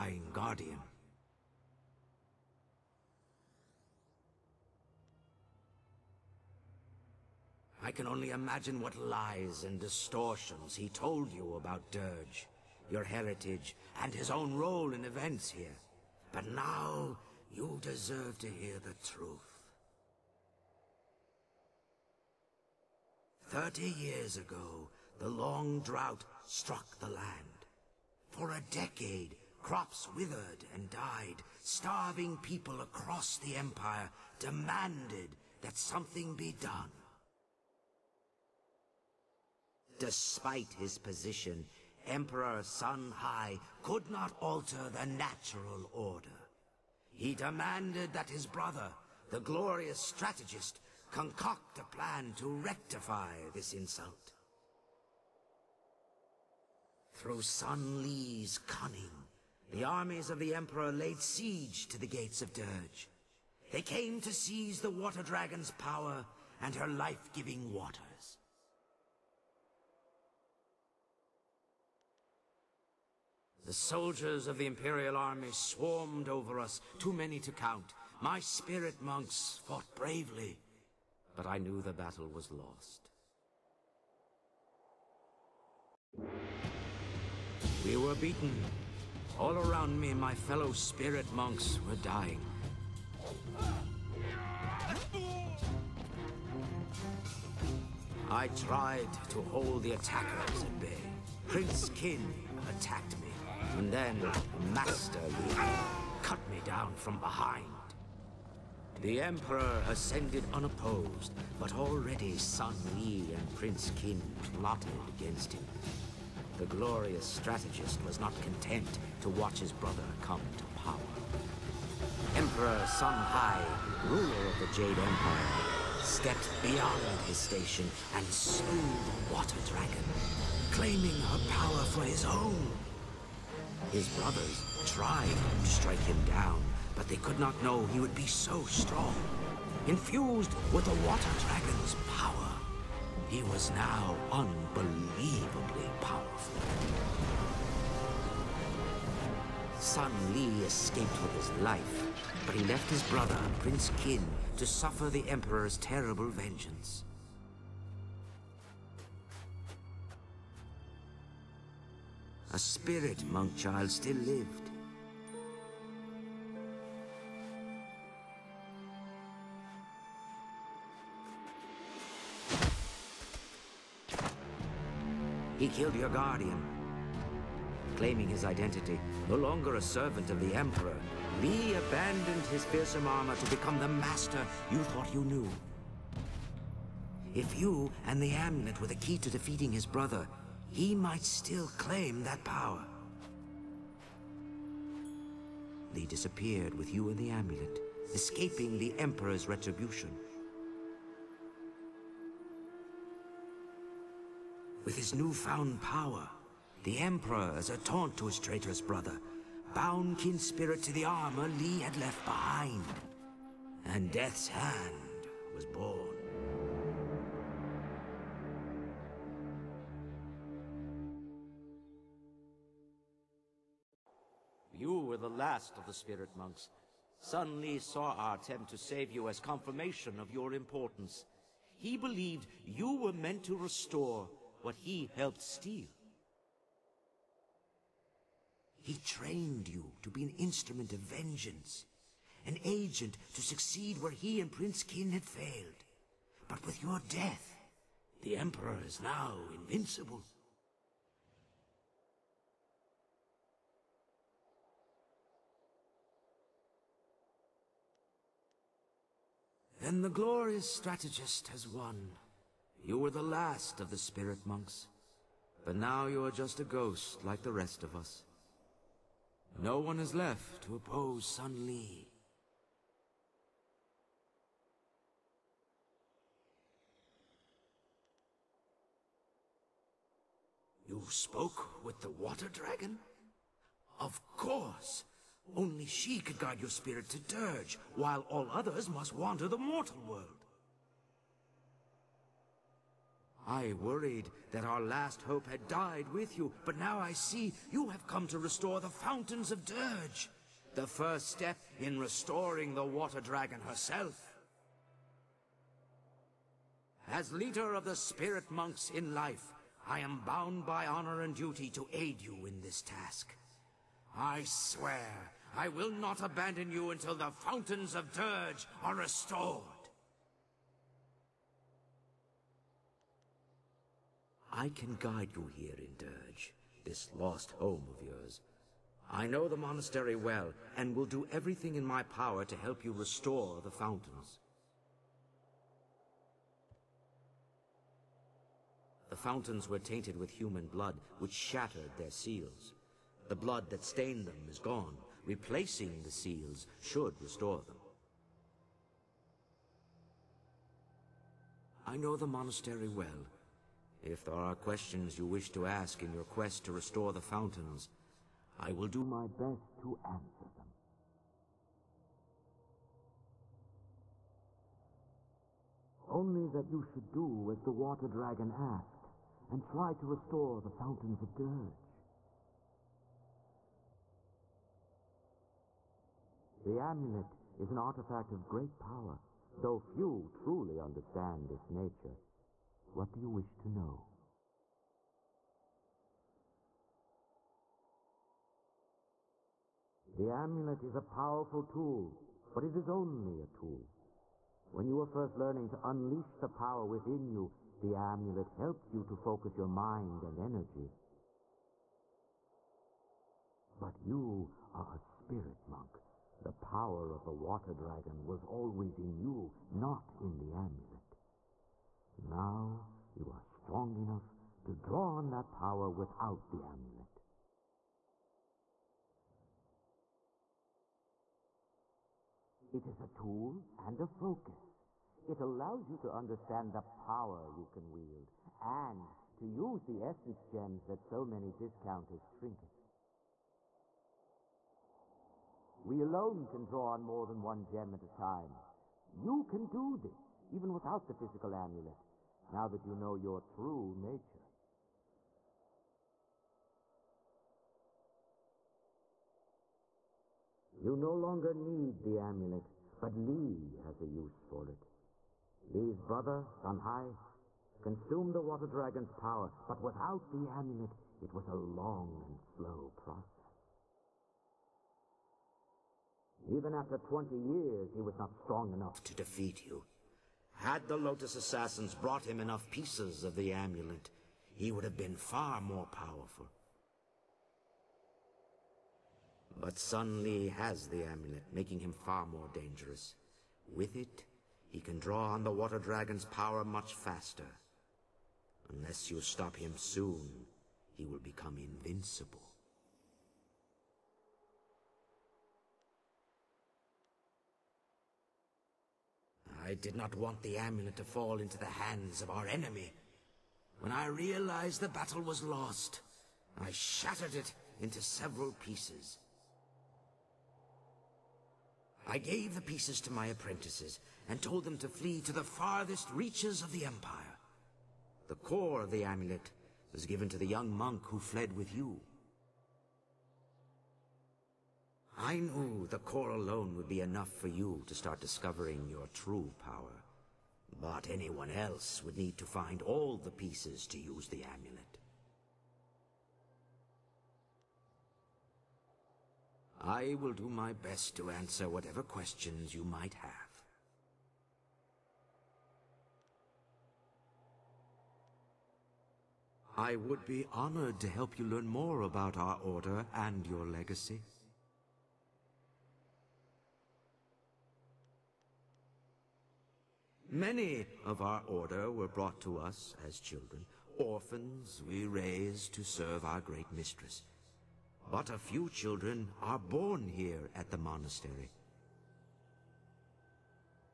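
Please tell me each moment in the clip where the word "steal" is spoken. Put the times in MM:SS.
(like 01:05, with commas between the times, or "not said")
03:55.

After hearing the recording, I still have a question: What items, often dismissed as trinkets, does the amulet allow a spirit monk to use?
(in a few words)
Essence gems.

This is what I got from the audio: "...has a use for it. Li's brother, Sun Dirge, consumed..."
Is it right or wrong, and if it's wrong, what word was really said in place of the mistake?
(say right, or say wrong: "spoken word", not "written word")
wrong: "Hai", not "Dirge".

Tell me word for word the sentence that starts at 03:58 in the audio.
He trained you to be an instrument of vengeance, an agent to succeed where he and Prince Kin had failed.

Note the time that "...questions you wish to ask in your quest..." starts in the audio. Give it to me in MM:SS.
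05:54.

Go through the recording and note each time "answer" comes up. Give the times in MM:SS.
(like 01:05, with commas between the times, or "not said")
06:00, 09:01.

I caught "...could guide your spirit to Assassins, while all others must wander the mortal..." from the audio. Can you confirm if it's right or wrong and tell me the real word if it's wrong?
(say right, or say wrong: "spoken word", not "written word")
wrong: "Dirge", not "Assassins".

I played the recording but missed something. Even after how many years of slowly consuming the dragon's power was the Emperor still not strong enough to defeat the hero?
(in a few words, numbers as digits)
20 years.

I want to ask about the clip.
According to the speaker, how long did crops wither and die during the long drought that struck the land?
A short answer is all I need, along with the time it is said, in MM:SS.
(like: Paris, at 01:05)
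A decade, at 00:28.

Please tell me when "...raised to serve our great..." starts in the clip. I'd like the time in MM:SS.
09:25.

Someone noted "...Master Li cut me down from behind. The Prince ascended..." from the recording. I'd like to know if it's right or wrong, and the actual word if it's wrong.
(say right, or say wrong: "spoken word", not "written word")
wrong: "Emperor", not "Prince".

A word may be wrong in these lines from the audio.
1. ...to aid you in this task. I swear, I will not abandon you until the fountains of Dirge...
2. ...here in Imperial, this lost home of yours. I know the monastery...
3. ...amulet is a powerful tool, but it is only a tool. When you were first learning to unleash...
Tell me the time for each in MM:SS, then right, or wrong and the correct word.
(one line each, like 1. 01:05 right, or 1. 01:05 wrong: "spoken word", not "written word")
1. 05:11 right
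2. 05:25 wrong: "Dirge", not "Imperial"
3. 06:30 right.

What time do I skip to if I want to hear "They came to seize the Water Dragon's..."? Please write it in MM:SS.
01:03.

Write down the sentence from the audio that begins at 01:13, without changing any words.
The soldiers of the Imperial army swarmed over us, too many to count.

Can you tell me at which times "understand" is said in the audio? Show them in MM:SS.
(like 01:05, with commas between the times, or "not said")
06:20, 07:06.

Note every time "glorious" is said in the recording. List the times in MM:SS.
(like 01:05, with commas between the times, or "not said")
00:49, 01:56, 04:20.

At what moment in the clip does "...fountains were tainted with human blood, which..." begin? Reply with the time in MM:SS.
05:39.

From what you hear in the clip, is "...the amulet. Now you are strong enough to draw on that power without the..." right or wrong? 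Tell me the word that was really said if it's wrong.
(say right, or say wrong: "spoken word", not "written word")
right.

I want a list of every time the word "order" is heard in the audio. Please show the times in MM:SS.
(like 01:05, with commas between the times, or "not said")
00:45, 09:12, 09:21.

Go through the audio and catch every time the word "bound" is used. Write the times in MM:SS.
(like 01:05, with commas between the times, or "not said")
03:29, 05:10.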